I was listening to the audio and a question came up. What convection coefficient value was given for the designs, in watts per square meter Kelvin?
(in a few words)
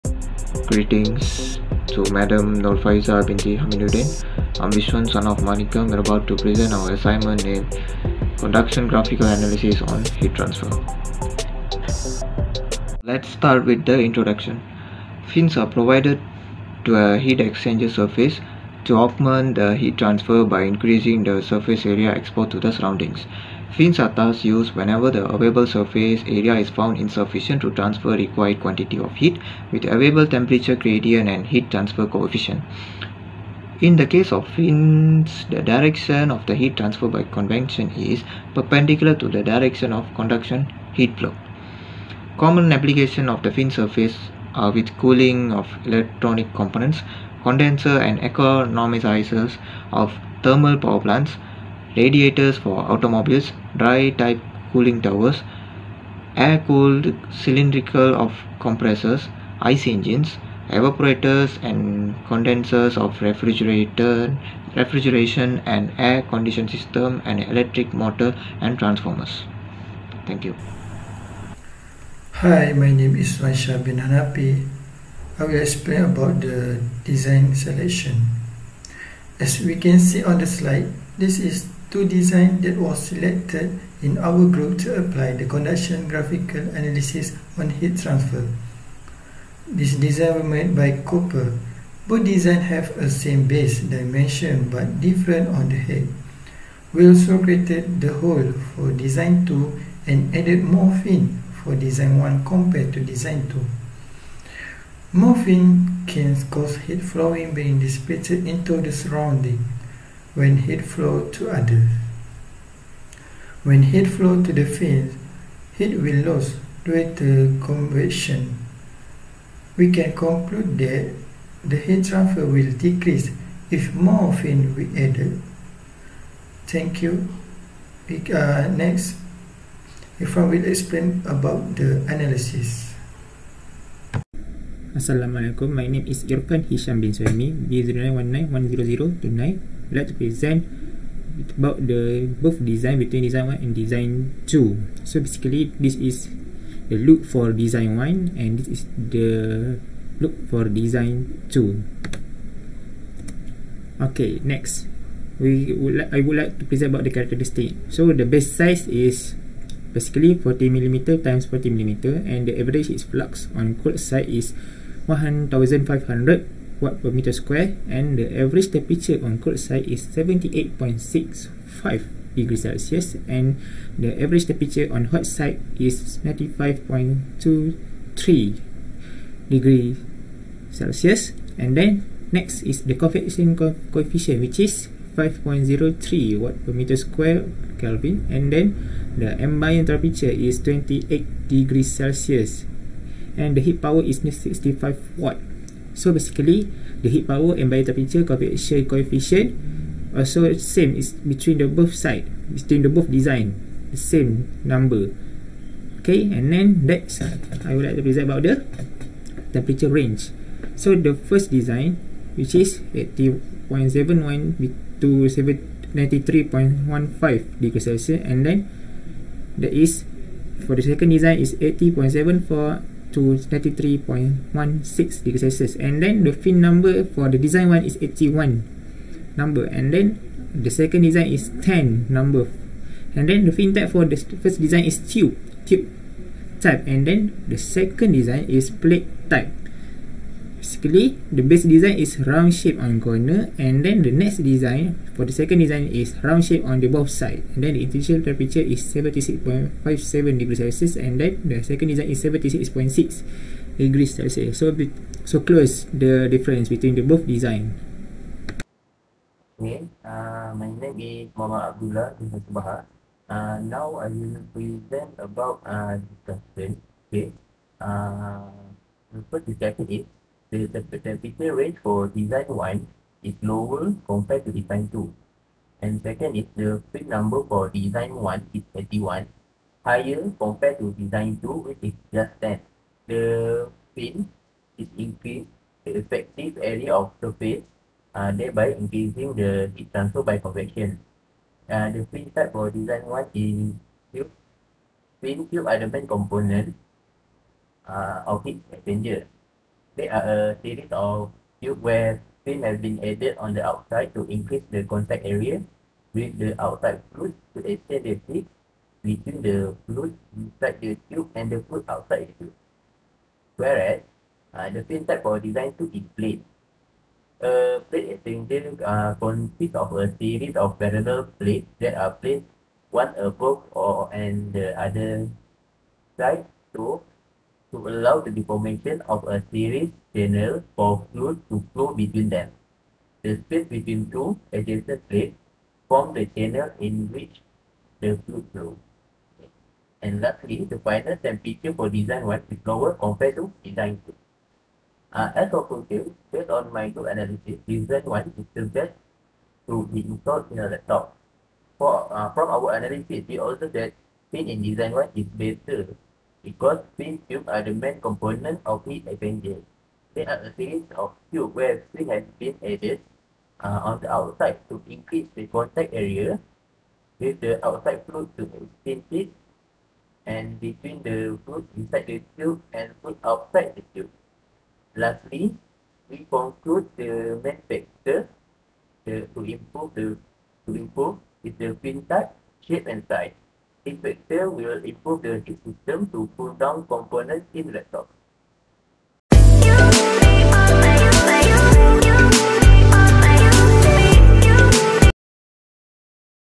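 5.03.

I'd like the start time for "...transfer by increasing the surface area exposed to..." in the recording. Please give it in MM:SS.
00:19.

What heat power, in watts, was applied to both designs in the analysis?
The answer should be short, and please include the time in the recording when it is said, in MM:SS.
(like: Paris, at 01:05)
65 watt, at 03:14.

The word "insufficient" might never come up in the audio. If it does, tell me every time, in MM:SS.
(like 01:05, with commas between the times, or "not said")
00:26.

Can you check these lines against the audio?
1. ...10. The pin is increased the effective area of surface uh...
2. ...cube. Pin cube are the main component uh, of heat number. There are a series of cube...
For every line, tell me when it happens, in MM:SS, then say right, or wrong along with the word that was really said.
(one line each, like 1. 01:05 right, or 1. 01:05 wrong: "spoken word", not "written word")
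1. 04:42 right
2. 04:54 wrong: "exchanger", not "number".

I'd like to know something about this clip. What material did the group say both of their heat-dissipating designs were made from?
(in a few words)
Copper.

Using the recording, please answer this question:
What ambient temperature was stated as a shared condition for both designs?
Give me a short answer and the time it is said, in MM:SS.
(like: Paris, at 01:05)
28 degrees Celsius, at 03:10.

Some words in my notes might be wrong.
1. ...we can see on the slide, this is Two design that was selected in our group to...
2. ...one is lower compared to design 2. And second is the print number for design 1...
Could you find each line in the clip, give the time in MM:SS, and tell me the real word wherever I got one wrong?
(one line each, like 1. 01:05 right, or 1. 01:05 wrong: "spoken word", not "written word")
1. 01:19 right
2. 04:32 right.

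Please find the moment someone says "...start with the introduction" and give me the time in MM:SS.
00:13.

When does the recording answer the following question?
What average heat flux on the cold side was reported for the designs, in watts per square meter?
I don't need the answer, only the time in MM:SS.
02:45.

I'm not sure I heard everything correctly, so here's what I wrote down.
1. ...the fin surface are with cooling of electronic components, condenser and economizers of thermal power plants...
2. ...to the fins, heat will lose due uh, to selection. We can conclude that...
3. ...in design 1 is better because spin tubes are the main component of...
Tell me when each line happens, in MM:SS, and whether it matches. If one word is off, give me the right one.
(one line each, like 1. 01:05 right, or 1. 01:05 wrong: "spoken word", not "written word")
1. 00:43 right
2. 01:54 wrong: "convection", not "selection"
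3. 05:54 right.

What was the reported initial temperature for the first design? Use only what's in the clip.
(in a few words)
76.57 degrees Celsius.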